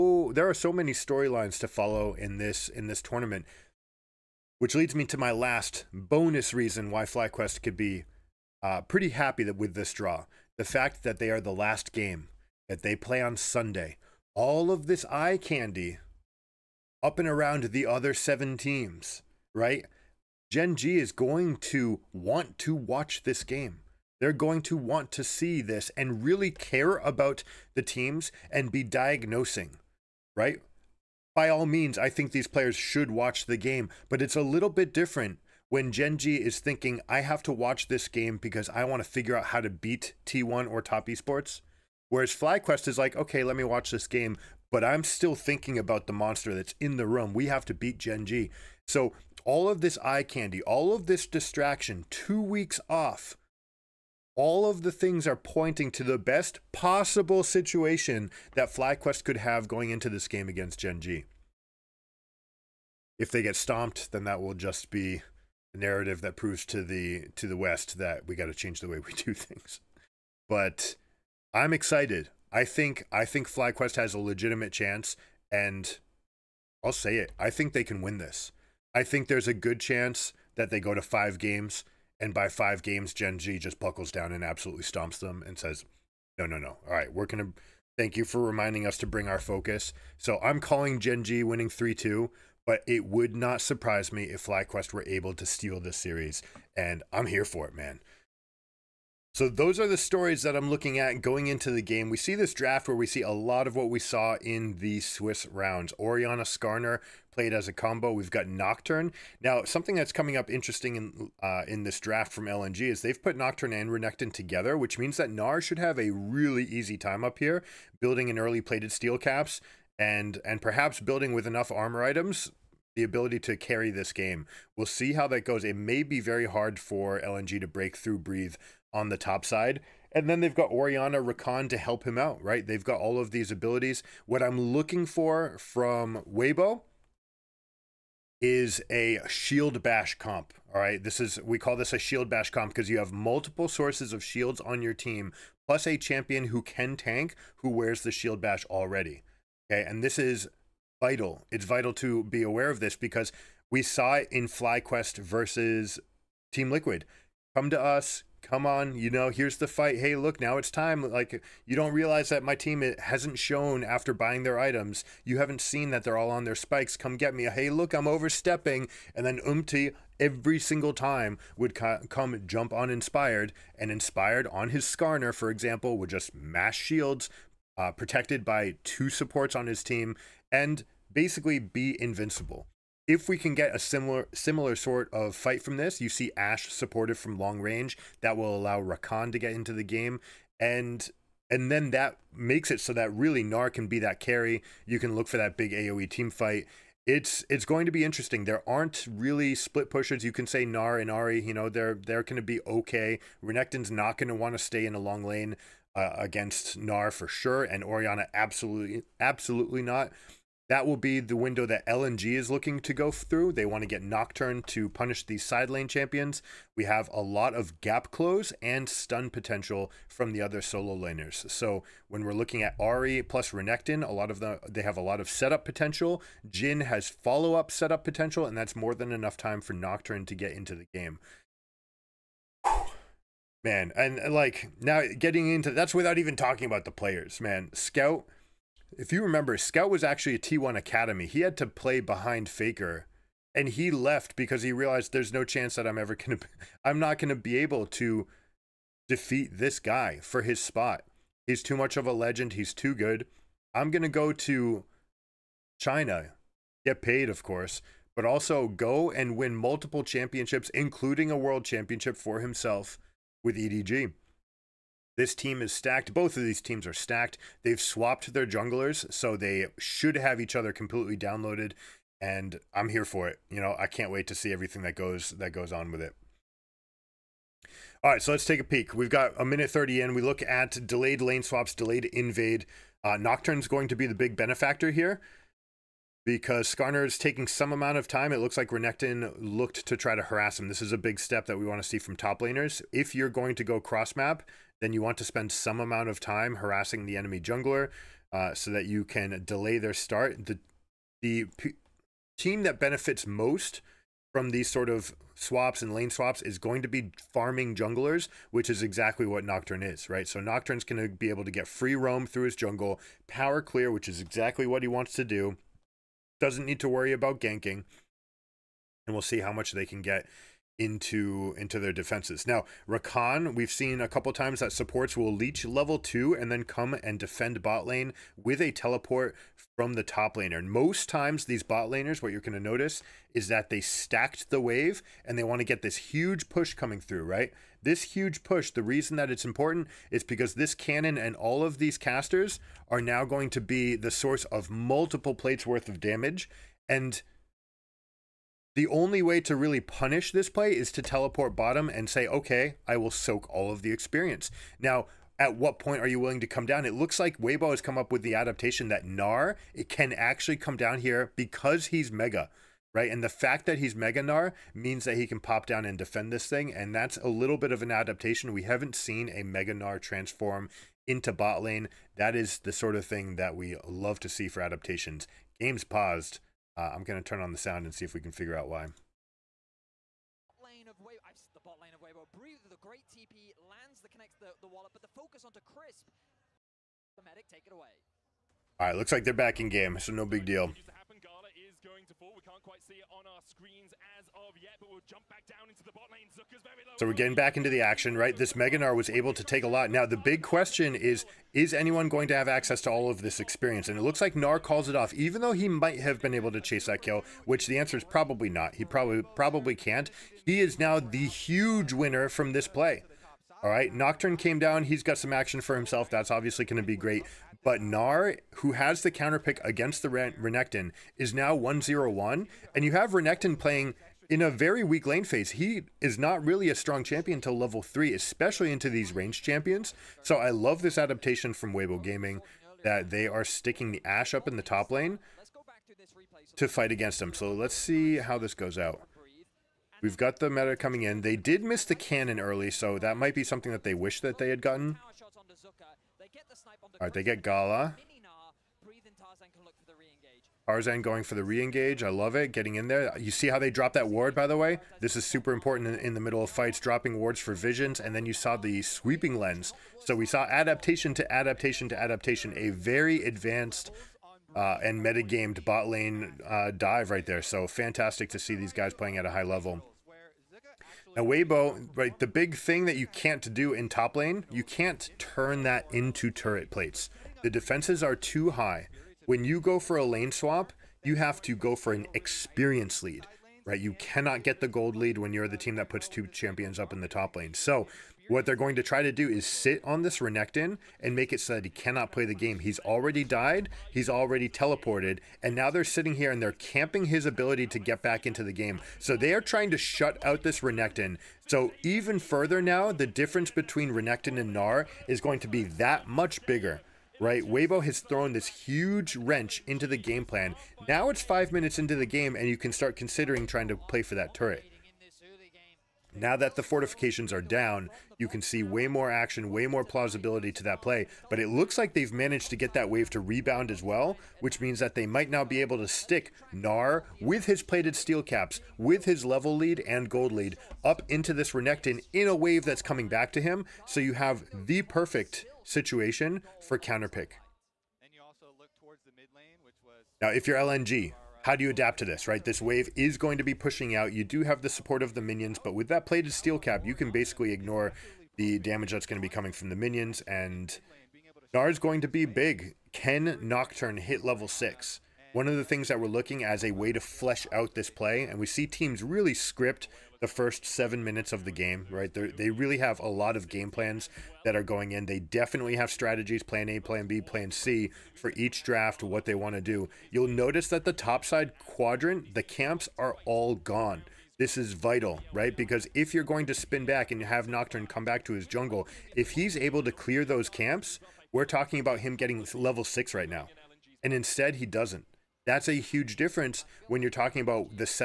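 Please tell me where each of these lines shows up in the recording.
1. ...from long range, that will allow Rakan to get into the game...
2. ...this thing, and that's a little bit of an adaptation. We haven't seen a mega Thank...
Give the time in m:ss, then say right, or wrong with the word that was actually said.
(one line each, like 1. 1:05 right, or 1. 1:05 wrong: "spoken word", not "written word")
1. 3:07 right
2. 6:06 wrong: "Gnar", not "Thank".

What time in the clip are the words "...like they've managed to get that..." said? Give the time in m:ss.
8:41.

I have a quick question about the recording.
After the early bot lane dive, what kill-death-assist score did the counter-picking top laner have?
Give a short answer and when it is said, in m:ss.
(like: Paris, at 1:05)
1-0-1, at 7:01.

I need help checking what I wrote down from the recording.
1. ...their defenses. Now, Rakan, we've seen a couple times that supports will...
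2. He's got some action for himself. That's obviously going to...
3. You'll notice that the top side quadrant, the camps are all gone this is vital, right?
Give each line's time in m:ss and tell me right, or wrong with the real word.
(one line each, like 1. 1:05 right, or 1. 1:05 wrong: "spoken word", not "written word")
1. 5:21 right
2. 6:54 right
3. 9:30 right.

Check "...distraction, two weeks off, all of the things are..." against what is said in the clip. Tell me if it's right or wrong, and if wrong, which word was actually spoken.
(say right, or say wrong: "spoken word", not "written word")
right.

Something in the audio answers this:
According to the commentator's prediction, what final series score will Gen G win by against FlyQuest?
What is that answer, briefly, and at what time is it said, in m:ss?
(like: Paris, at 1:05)
3-2, at 1:31.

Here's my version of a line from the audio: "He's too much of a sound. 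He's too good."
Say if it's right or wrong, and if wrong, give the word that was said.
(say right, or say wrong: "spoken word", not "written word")
wrong: "legend", not "sound".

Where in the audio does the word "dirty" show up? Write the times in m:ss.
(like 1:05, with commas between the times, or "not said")
not said.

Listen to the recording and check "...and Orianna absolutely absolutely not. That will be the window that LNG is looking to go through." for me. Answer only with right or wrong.
right.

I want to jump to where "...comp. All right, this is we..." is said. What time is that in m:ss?
2:20.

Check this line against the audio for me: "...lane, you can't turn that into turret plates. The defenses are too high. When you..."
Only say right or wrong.
right.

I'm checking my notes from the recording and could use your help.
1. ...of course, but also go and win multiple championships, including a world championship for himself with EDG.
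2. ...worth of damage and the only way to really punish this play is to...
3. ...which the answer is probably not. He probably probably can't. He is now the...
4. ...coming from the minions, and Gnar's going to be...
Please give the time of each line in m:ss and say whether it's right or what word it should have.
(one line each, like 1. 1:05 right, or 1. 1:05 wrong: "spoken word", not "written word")
1. 4:17 right
2. 5:45 right
3. 6:47 right
4. 9:09 right.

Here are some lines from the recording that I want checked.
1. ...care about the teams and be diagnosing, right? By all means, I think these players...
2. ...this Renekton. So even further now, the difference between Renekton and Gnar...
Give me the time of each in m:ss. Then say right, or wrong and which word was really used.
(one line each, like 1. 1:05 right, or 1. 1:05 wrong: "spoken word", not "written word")
1. 0:26 right
2. 8:20 right.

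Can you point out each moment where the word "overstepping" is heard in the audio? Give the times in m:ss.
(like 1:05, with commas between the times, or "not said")
2:48.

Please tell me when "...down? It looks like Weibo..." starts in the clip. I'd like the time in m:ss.
5:56.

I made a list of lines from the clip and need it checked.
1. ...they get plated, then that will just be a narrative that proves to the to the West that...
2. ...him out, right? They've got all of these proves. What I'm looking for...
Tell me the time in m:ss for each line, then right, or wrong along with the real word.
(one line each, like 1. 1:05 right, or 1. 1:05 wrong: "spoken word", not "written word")
1. 1:03 wrong: "stomped", not "plated"
2. 2:12 wrong: "abilities", not "proves".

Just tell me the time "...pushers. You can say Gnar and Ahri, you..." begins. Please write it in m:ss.
3:19.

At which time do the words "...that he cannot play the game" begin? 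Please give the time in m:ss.
8:11.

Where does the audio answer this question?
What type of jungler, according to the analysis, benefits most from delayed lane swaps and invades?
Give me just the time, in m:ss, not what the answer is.
5:07.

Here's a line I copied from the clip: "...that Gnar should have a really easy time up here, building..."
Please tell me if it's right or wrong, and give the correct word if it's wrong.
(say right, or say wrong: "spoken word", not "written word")
right.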